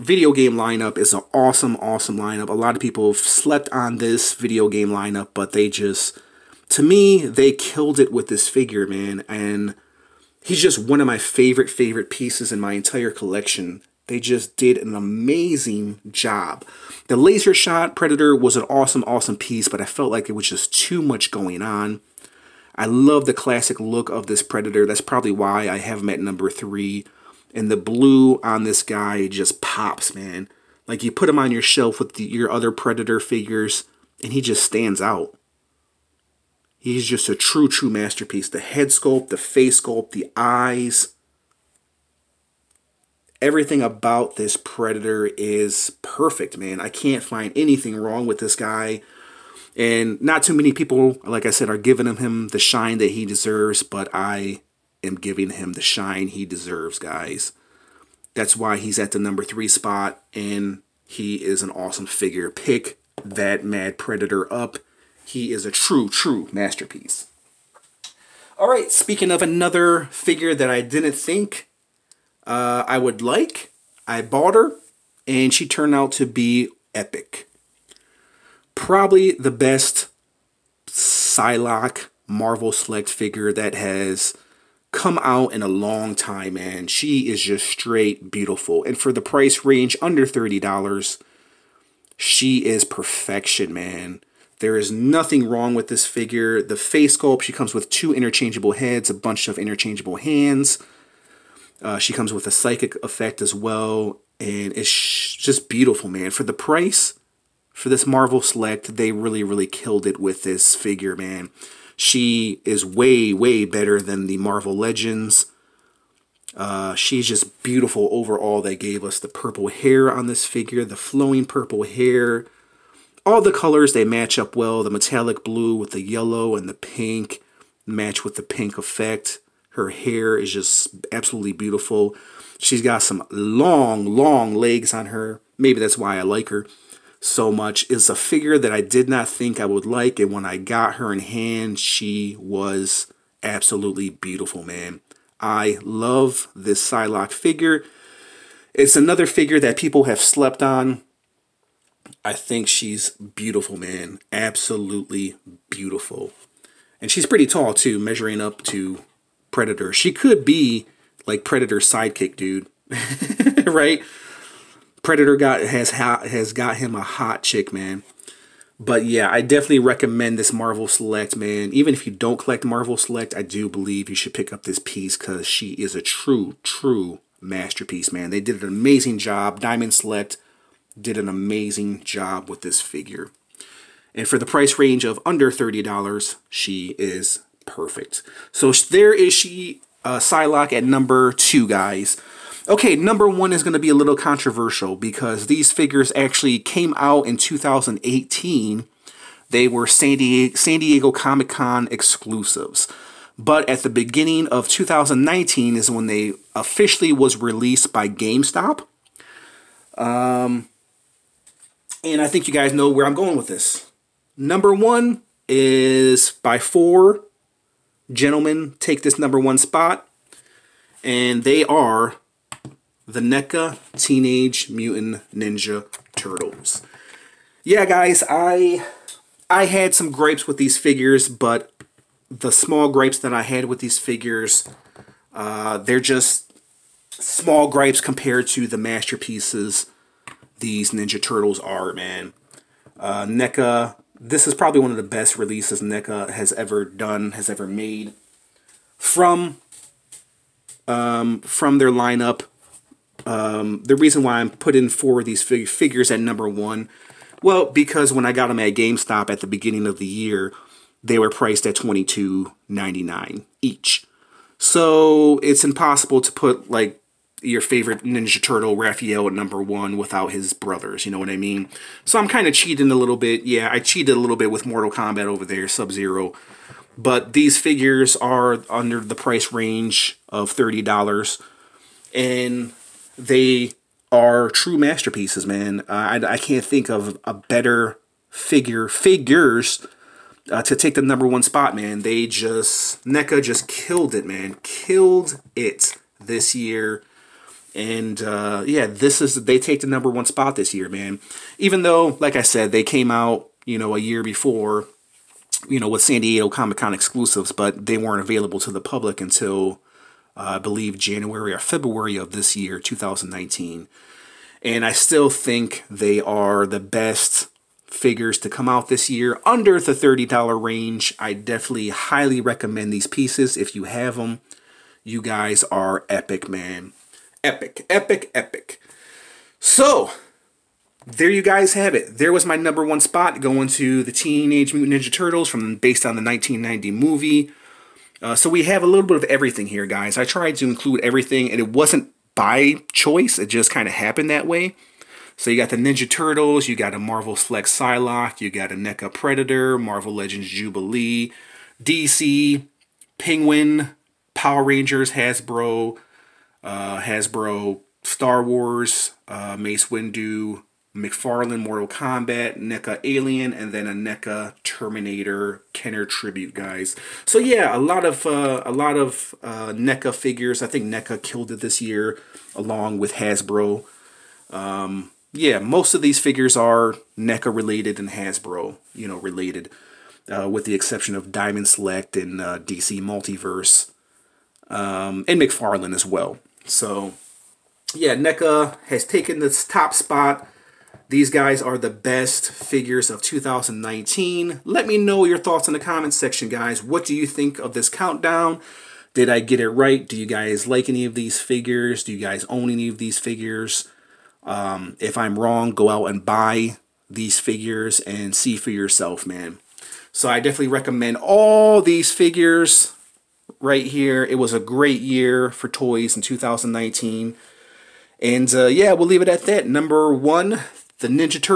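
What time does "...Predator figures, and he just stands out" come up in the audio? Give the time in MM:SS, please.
00:32.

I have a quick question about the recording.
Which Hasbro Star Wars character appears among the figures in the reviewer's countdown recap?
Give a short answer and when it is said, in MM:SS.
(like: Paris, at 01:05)
Mace Windu, at 05:59.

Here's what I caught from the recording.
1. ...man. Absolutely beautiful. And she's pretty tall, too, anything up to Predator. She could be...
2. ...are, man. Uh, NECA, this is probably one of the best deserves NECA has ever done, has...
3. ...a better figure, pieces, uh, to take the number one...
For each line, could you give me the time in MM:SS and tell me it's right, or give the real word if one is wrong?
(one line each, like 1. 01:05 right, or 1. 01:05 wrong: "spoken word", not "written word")
1. 02:33 wrong: "measuring", not "anything"
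2. 04:01 wrong: "releases", not "deserves"
3. 04:47 wrong: "figures", not "pieces".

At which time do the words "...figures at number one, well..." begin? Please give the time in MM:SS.
04:15.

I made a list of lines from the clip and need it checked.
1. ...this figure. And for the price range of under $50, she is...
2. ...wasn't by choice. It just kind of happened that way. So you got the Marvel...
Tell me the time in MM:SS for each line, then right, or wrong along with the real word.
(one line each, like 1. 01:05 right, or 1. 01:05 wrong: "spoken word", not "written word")
1. 03:02 wrong: "30", not "50"
2. 05:41 wrong: "Ninja", not "Marvel".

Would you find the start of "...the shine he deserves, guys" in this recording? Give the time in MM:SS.
00:55.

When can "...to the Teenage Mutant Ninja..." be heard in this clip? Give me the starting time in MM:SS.
05:33.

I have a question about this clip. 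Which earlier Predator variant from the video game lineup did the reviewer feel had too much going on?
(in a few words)
Laser Shot Predator.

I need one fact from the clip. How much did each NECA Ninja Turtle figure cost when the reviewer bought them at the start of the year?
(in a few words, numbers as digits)
$22.99.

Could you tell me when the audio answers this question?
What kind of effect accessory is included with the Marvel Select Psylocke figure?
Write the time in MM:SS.
01:42.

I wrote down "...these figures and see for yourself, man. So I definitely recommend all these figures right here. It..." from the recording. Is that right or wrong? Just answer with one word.
right.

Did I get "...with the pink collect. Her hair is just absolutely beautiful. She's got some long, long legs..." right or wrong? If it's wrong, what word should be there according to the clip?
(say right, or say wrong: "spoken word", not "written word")
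wrong: "effect", not "collect".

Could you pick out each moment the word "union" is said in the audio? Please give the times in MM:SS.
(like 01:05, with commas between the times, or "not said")
not said.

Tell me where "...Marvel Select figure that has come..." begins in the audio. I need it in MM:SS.
01:22.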